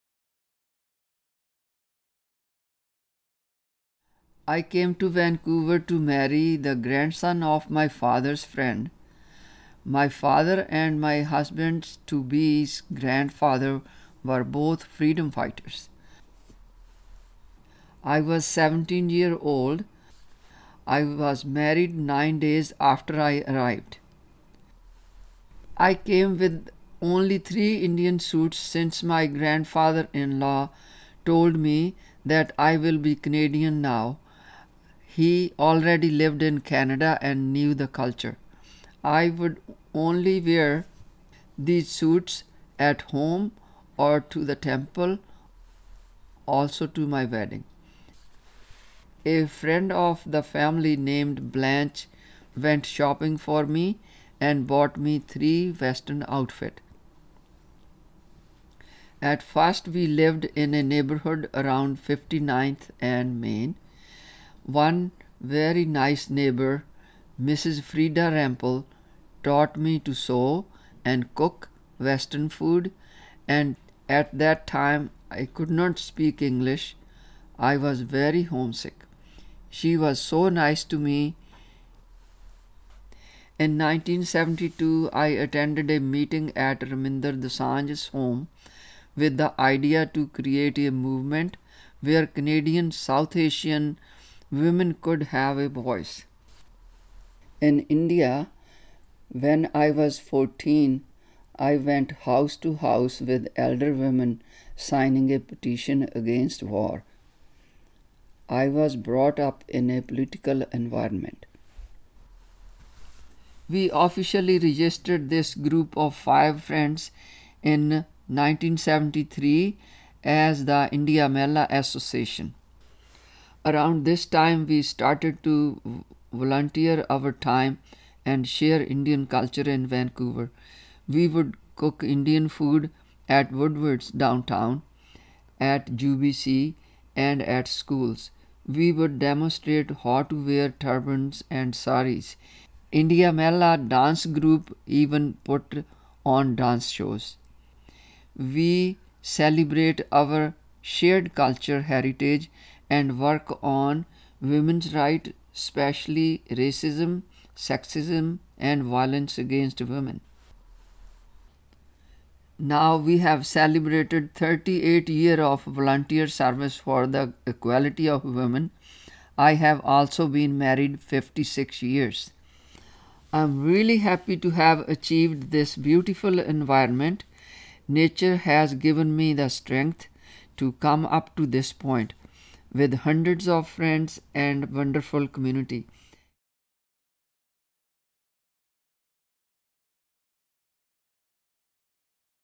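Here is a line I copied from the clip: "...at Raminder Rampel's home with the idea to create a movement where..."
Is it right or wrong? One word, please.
wrong.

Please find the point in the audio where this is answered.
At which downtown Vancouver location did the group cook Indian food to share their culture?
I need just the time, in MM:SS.
02:13.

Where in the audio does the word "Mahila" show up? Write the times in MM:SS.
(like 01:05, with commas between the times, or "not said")
02:01, 02:23.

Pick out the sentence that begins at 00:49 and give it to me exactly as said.
A friend of the family named Blanche went shopping for me and bought me three western outfit.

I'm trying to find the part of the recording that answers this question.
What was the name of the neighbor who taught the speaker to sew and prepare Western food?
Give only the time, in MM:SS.
01:07.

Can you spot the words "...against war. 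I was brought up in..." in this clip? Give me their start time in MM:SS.
01:46.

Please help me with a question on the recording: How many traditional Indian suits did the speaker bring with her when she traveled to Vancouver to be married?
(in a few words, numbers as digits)
3.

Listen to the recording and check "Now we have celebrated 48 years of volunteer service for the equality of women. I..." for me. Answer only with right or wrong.
wrong.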